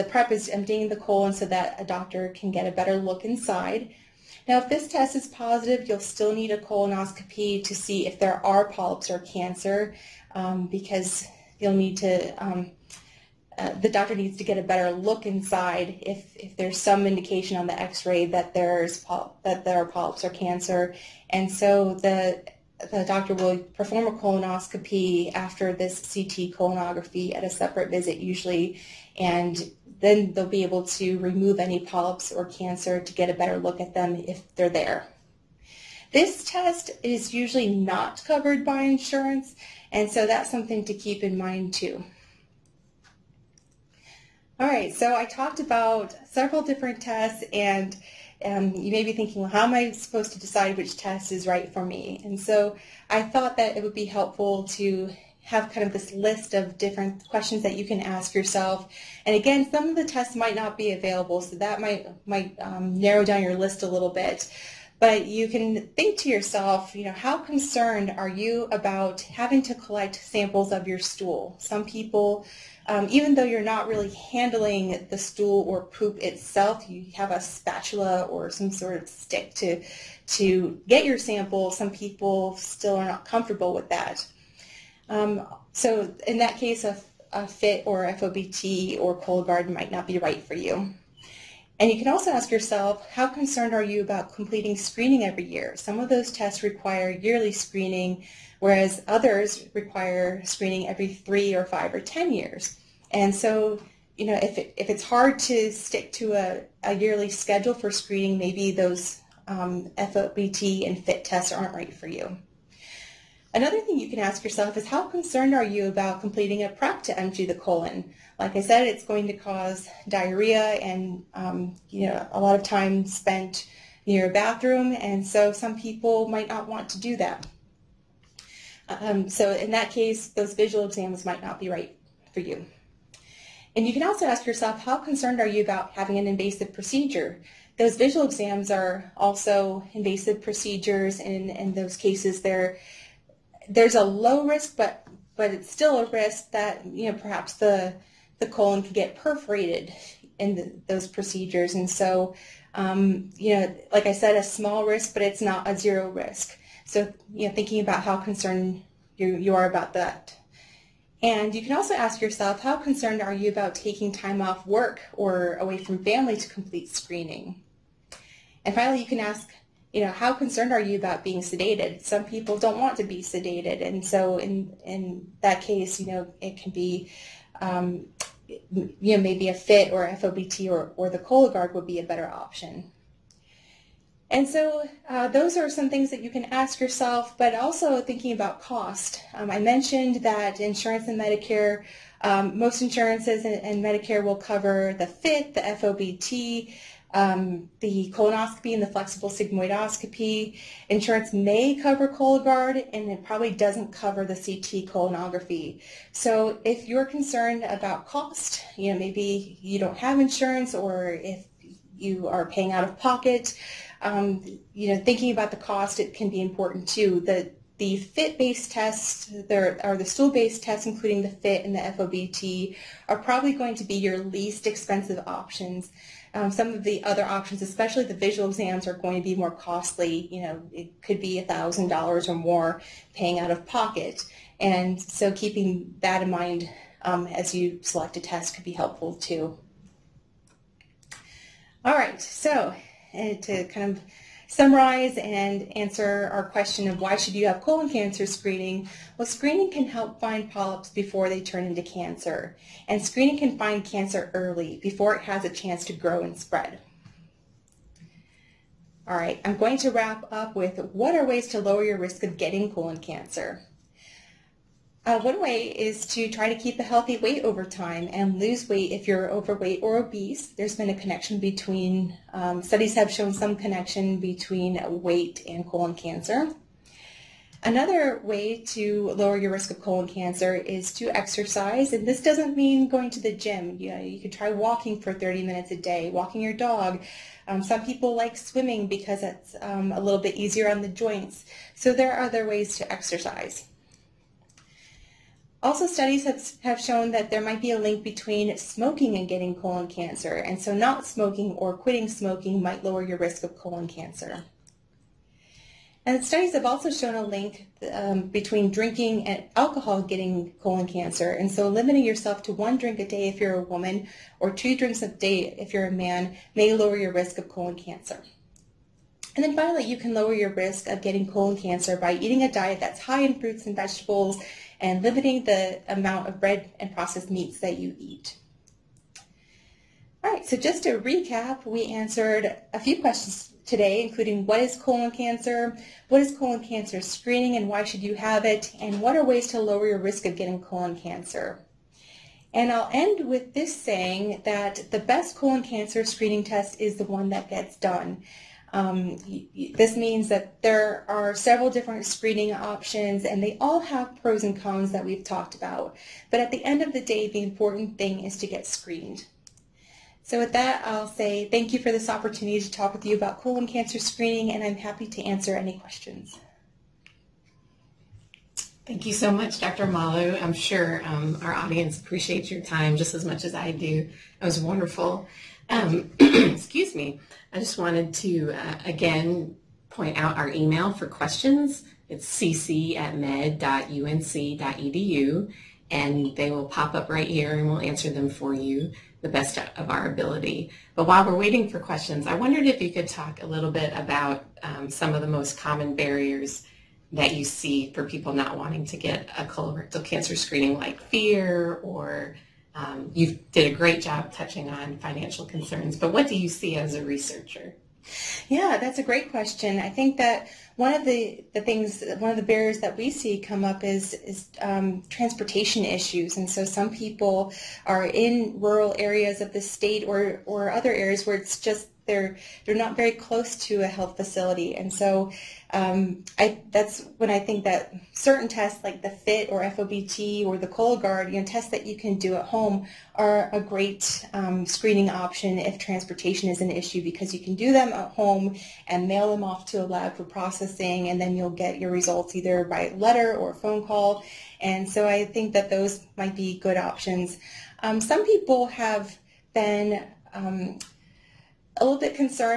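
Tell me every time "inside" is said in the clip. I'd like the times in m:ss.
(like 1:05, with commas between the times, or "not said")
0:03, 0:15.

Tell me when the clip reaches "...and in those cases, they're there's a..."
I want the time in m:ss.
2:21.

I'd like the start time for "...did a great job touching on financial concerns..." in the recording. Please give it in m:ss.
6:43.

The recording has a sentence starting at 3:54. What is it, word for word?
And so keeping that in mind um, as you select a test could be helpful too.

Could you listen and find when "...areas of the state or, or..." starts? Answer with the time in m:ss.
6:58.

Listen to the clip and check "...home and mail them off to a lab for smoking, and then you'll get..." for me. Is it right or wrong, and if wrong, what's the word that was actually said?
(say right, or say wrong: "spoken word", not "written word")
wrong: "processing", not "smoking".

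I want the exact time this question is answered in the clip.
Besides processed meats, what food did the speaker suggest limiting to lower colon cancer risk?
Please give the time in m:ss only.
5:26.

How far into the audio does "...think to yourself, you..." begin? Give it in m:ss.
1:05.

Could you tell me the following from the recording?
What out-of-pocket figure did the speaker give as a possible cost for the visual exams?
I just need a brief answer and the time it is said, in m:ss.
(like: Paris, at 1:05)
$1,000, at 3:51.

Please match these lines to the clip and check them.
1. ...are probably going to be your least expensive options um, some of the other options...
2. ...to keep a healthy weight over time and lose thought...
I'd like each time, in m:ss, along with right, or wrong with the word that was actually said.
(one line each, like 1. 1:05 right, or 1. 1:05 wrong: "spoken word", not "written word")
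1. 3:43 right
2. 4:26 wrong: "weight", not "thought".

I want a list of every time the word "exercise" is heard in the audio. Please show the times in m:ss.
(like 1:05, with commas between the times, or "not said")
4:41, 4:52.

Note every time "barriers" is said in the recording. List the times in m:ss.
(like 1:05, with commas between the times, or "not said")
6:35, 6:52.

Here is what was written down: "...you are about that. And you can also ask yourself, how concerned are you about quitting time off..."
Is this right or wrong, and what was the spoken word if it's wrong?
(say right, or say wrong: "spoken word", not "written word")
wrong: "taking", not "quitting".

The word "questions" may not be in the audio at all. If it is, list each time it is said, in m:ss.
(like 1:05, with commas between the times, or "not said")
0:57, 4:06, 5:32, 6:05, 6:21, 6:31, 6:49.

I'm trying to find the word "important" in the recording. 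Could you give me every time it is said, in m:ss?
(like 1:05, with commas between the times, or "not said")
3:36, 5:57.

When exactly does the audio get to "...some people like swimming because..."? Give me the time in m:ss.
4:47.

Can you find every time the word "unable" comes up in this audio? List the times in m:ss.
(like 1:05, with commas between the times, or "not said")
not said.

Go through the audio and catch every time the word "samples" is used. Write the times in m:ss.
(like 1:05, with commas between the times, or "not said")
1:10, 1:21.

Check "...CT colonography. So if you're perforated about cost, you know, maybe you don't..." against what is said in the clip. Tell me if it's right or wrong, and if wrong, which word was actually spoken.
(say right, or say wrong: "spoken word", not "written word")
wrong: "concerned", not "perforated".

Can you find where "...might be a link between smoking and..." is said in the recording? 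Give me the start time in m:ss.
4:57.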